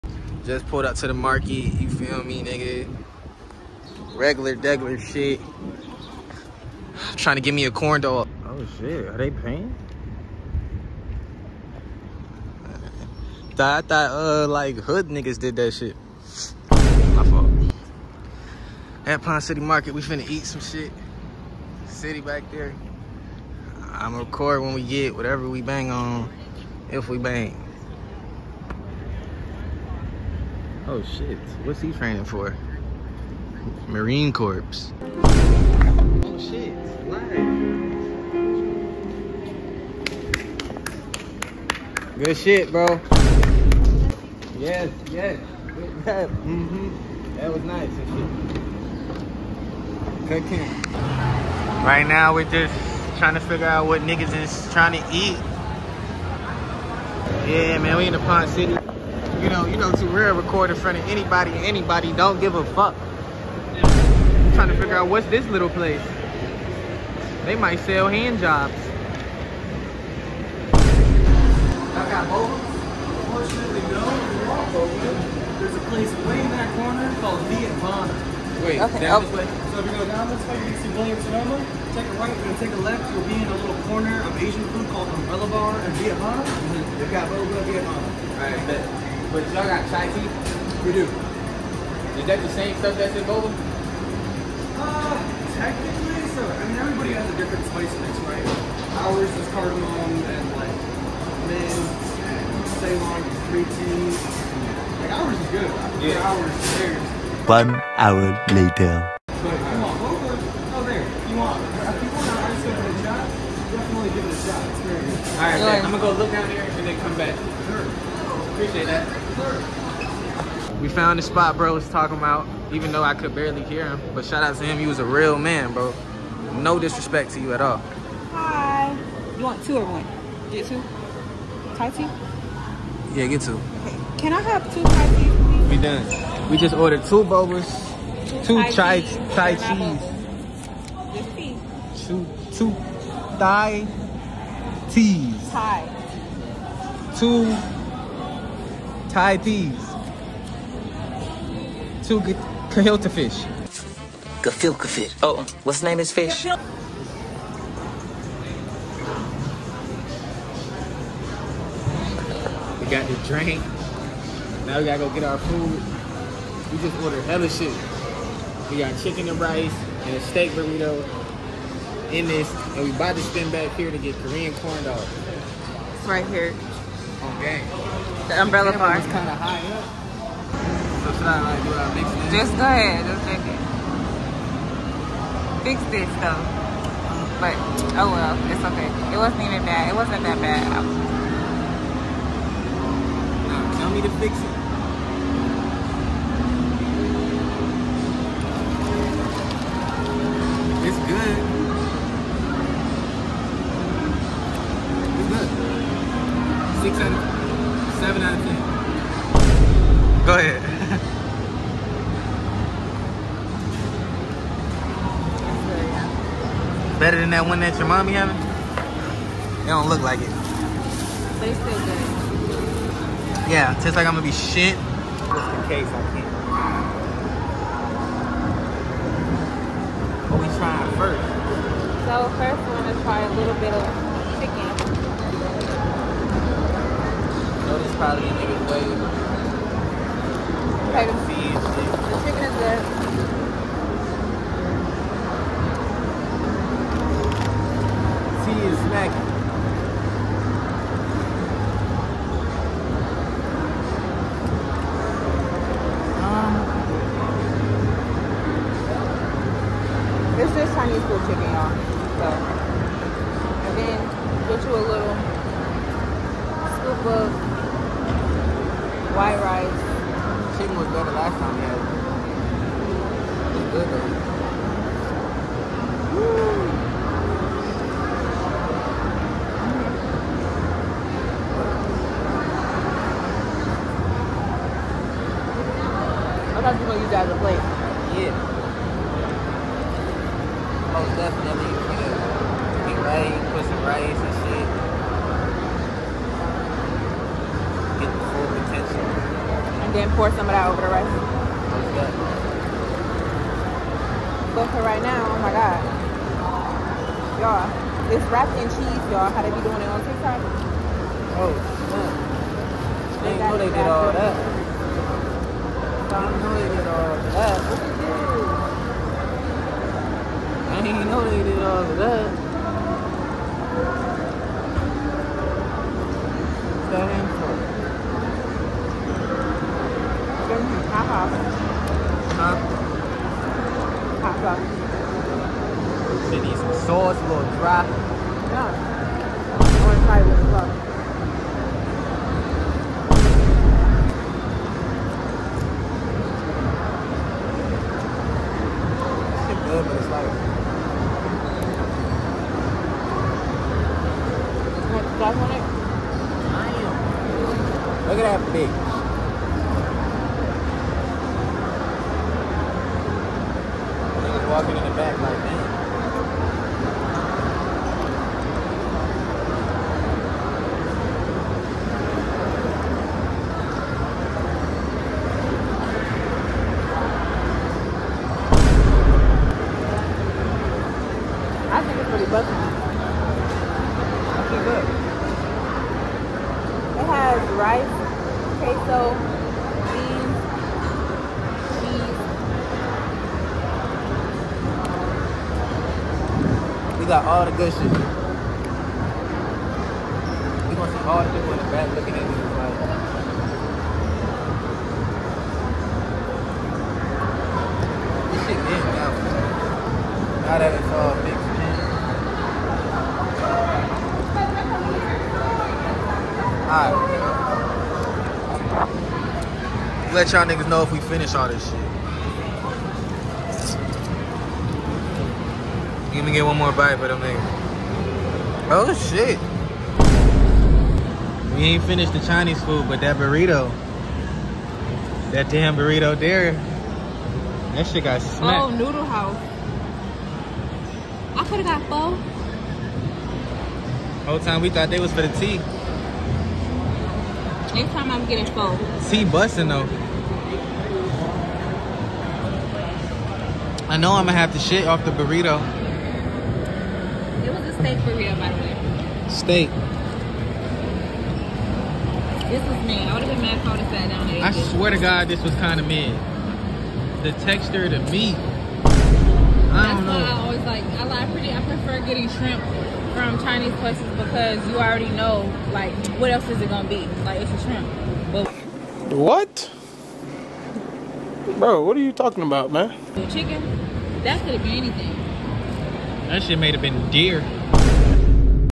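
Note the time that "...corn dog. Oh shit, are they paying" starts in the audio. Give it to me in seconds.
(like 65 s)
7 s.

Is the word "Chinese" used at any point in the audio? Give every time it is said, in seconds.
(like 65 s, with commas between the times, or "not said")
260 s, 432 s, 473 s.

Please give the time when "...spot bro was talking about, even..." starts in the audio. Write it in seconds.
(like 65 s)
121 s.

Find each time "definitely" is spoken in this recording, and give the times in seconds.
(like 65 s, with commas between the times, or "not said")
113 s, 291 s, 301 s.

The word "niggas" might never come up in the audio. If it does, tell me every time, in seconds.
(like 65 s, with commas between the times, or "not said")
2 s, 15 s, 54 s, 238 s, 364 s, 420 s, 427 s.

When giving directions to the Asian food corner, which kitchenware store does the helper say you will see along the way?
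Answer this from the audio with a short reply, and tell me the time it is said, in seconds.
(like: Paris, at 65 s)
William Sonoma, at 80 s.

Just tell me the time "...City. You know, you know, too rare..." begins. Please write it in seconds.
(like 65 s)
58 s.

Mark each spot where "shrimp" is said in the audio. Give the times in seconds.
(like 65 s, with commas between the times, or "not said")
472 s, 477 s.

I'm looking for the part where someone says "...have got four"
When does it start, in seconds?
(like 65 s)
441 s.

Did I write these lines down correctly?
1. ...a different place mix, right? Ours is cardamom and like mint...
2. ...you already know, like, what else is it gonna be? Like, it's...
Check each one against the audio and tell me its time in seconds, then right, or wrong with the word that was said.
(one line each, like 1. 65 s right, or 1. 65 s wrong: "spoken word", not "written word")
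1. 97 s wrong: "spice", not "place"
2. 474 s right.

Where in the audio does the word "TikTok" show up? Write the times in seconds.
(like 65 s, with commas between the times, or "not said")
310 s.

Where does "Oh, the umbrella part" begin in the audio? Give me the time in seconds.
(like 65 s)
177 s.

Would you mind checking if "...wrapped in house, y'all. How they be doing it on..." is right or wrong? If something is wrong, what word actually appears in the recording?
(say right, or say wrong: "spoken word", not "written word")
wrong: "cheese", not "house".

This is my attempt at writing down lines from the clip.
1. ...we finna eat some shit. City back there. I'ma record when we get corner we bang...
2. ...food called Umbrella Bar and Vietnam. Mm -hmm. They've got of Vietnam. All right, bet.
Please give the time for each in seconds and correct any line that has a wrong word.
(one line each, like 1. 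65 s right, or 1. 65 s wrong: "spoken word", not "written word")
1. 19 s wrong: "whatever", not "corner"
2. 84 s right.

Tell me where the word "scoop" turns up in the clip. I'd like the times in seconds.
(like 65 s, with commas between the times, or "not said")
266 s.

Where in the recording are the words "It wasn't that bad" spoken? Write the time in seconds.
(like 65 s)
189 s.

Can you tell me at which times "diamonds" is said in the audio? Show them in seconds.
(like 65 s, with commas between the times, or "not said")
not said.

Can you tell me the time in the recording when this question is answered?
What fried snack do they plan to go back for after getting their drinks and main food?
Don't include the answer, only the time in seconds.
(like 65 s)
174 s.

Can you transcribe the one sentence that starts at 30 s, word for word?
Oh shit, what's he training for?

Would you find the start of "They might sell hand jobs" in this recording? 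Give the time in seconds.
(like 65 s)
67 s.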